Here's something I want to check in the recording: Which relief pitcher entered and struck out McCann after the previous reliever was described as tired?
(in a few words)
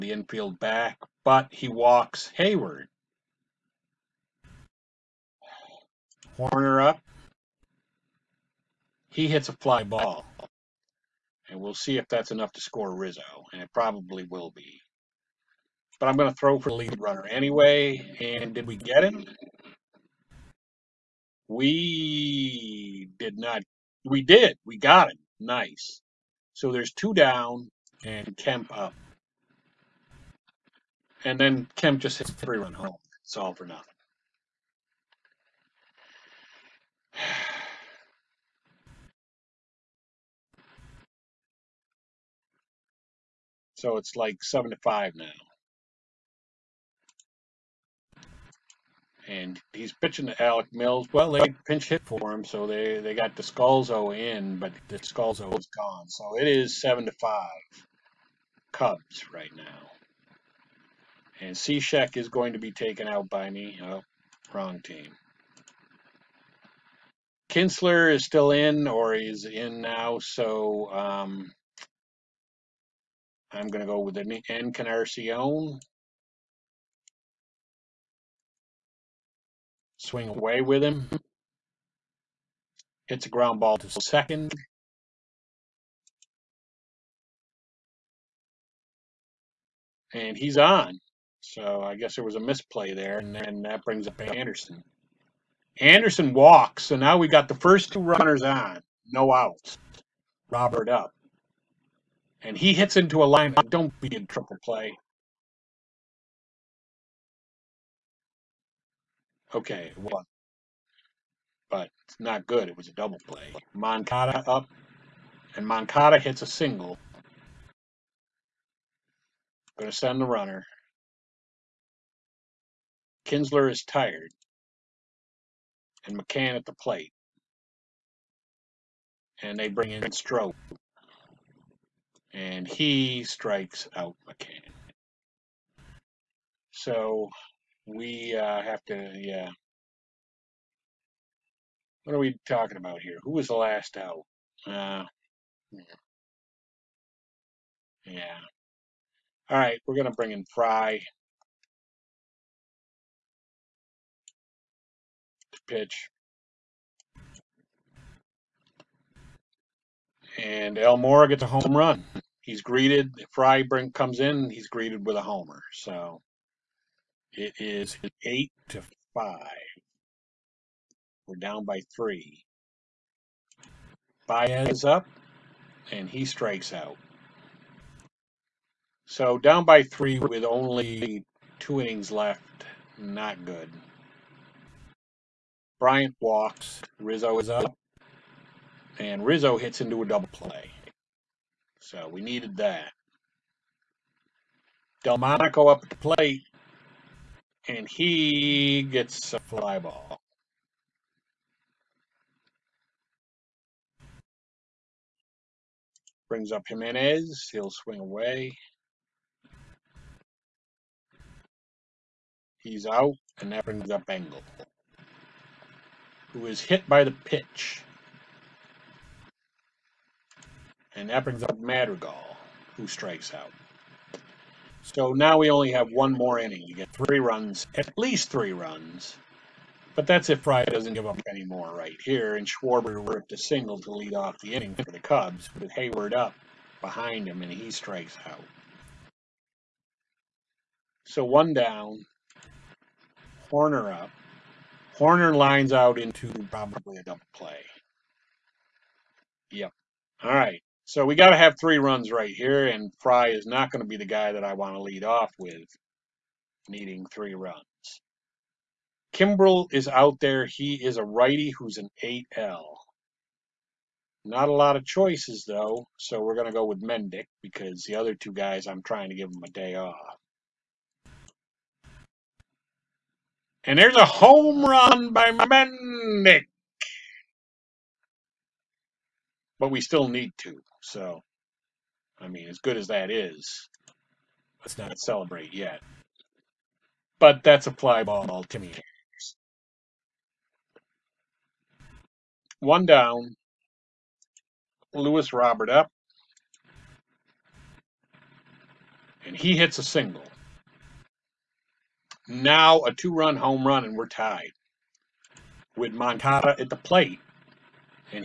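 Strop.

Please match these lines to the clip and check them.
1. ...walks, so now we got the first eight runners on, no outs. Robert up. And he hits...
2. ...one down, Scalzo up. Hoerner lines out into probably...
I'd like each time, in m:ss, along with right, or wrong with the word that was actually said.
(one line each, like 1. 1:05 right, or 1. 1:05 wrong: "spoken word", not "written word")
1. 1:36 wrong: "two", not "eight"
2. 4:01 wrong: "Hoerner", not "Scalzo".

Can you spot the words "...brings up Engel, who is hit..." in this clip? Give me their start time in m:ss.
3:33.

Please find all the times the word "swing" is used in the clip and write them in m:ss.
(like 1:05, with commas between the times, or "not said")
1:20, 3:27.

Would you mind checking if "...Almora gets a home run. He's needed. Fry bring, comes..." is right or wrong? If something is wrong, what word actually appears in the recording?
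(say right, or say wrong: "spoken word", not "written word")
wrong: "greeted", not "needed".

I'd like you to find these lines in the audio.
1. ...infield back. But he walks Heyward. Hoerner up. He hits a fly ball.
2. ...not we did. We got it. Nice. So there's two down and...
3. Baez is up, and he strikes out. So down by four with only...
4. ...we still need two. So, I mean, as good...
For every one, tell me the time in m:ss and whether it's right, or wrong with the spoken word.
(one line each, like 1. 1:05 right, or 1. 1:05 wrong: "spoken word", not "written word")
1. 0:00 right
2. 0:23 right
3. 2:54 wrong: "three", not "four"
4. 4:39 right.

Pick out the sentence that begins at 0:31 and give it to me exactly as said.
And then Kemp just hits three run home.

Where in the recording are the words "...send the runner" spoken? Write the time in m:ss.
1:59.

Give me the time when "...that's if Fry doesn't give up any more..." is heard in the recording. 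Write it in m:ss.
3:50.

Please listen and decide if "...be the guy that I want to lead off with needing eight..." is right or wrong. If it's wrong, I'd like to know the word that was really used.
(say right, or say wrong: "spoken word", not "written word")
wrong: "three", not "eight".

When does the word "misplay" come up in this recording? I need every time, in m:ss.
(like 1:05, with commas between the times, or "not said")
1:32.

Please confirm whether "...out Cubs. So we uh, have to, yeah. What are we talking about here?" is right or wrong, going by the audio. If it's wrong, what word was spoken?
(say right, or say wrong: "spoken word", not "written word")
wrong: "McCann", not "Cubs".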